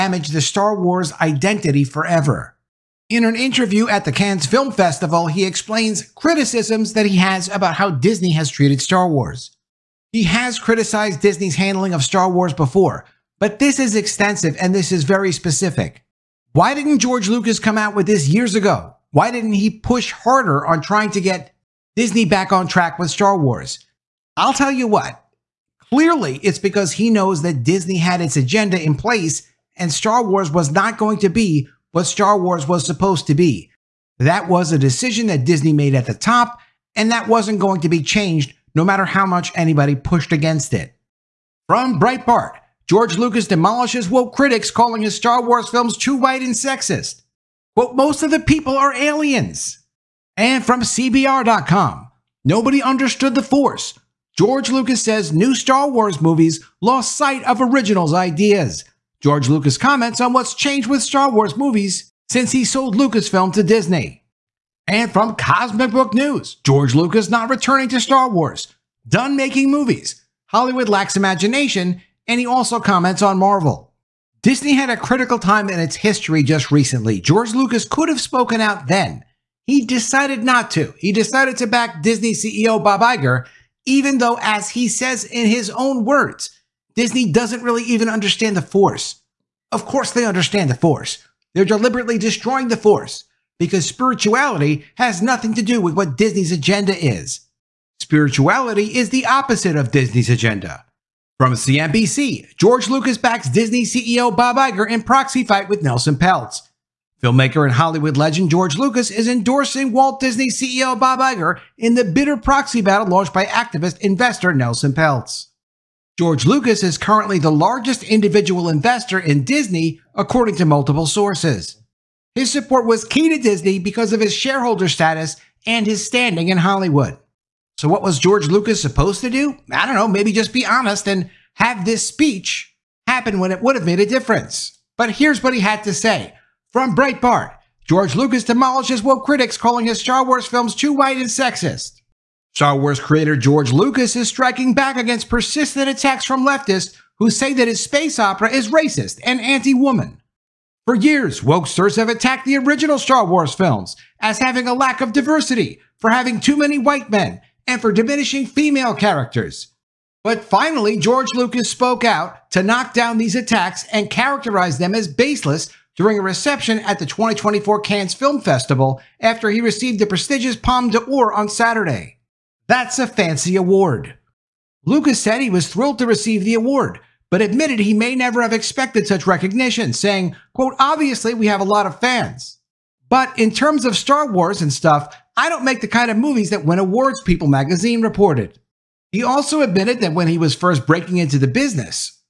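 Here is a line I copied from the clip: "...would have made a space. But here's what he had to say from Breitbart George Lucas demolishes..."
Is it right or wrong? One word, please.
wrong.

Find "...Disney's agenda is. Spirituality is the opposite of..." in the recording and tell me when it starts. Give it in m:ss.
1:36.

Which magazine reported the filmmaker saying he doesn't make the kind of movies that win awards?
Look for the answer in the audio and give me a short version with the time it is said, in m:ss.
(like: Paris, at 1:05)
People magazine, at 3:07.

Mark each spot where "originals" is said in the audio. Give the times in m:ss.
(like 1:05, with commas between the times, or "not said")
0:57, 2:32.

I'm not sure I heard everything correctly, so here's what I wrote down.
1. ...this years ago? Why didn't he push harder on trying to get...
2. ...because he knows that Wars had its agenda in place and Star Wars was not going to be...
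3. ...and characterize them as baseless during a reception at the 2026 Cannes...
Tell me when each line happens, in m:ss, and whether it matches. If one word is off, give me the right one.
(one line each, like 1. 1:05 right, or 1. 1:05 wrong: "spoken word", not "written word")
1. 0:18 right
2. 0:26 wrong: "Disney", not "Wars"
3. 2:43 wrong: "2024", not "2026".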